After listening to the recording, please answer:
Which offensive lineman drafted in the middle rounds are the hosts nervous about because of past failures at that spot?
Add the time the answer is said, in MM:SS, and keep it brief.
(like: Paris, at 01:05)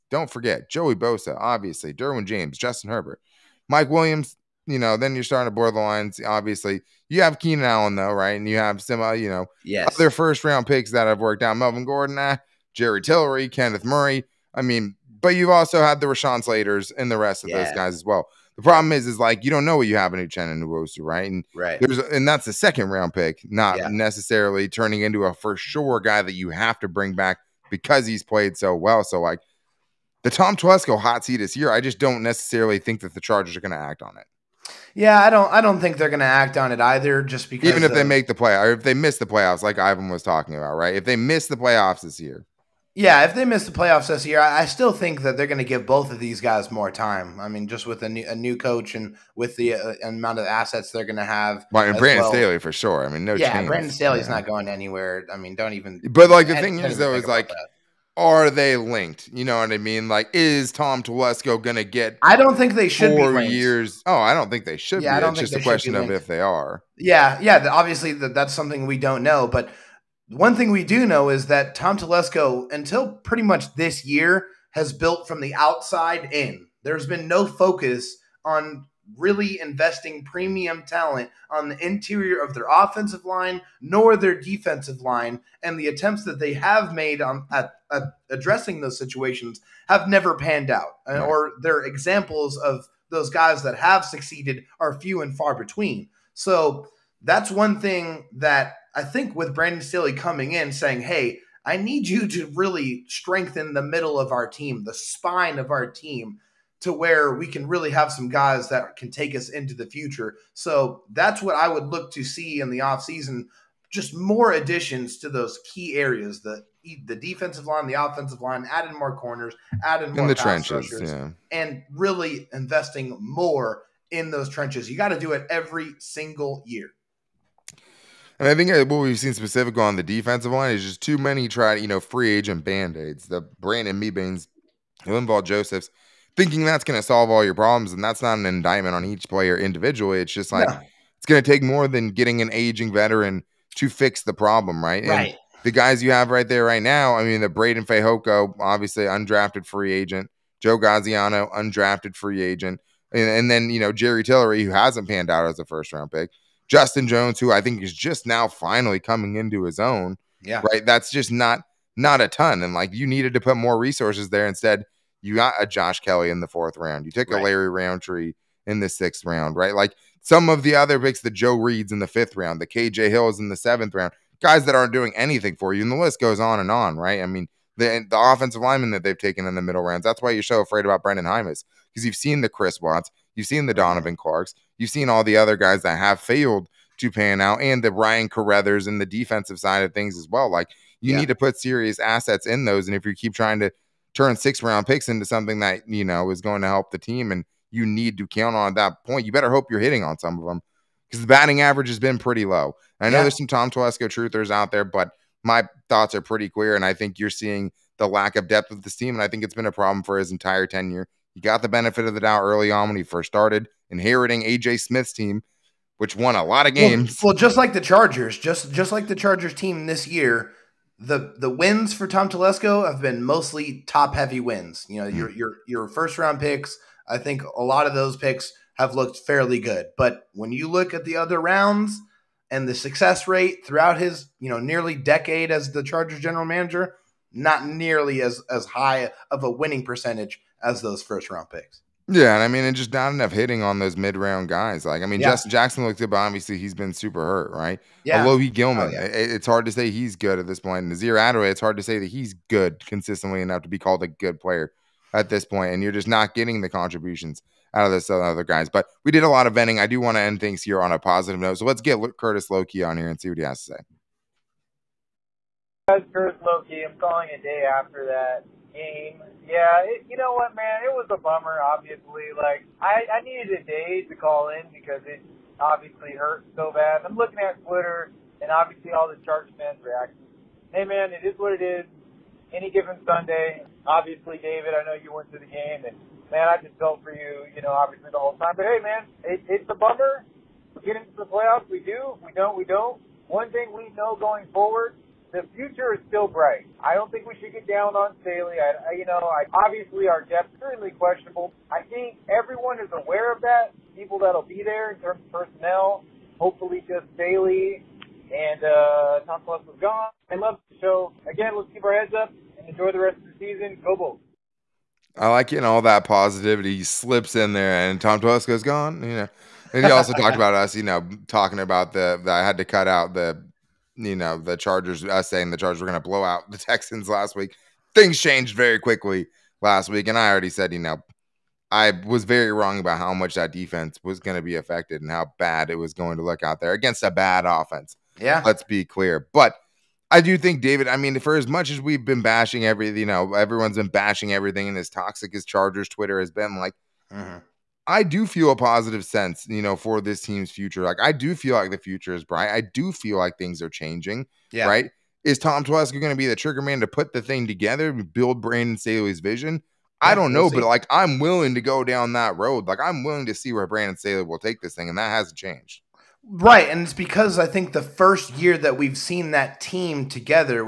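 Brenden Jaimes, at 03:01.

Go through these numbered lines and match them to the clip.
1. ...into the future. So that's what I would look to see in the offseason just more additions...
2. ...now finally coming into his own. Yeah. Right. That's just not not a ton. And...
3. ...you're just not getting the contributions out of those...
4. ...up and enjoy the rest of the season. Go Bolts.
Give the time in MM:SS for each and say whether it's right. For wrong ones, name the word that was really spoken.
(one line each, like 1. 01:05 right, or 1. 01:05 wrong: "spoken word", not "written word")
1. 01:49 right
2. 02:38 right
3. 04:15 right
4. 05:12 right.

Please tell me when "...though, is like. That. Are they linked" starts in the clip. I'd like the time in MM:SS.
00:56.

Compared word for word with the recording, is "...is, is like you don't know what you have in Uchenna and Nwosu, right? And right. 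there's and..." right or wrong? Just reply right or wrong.
right.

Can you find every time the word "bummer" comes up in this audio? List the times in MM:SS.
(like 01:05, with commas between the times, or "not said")
04:31, 04:49.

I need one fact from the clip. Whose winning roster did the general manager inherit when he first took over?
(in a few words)
AJ Smith's.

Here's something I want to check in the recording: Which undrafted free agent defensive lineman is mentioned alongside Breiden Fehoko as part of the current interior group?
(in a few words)
Joe Gaziano.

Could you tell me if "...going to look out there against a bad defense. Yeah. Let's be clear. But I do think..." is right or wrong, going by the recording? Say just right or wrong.
wrong.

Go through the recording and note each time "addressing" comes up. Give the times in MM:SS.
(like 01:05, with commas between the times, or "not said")
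01:28.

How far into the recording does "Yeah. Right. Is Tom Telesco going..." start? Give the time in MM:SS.
05:54.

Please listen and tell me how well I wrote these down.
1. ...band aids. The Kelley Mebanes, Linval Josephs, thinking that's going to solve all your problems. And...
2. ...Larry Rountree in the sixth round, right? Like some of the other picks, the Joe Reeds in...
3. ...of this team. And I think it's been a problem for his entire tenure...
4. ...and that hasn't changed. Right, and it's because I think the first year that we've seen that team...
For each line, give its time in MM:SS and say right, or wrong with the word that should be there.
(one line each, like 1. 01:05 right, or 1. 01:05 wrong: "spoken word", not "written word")
1. 02:12 wrong: "Brandon", not "Kelley"
2. 02:47 right
3. 03:28 right
4. 06:04 right.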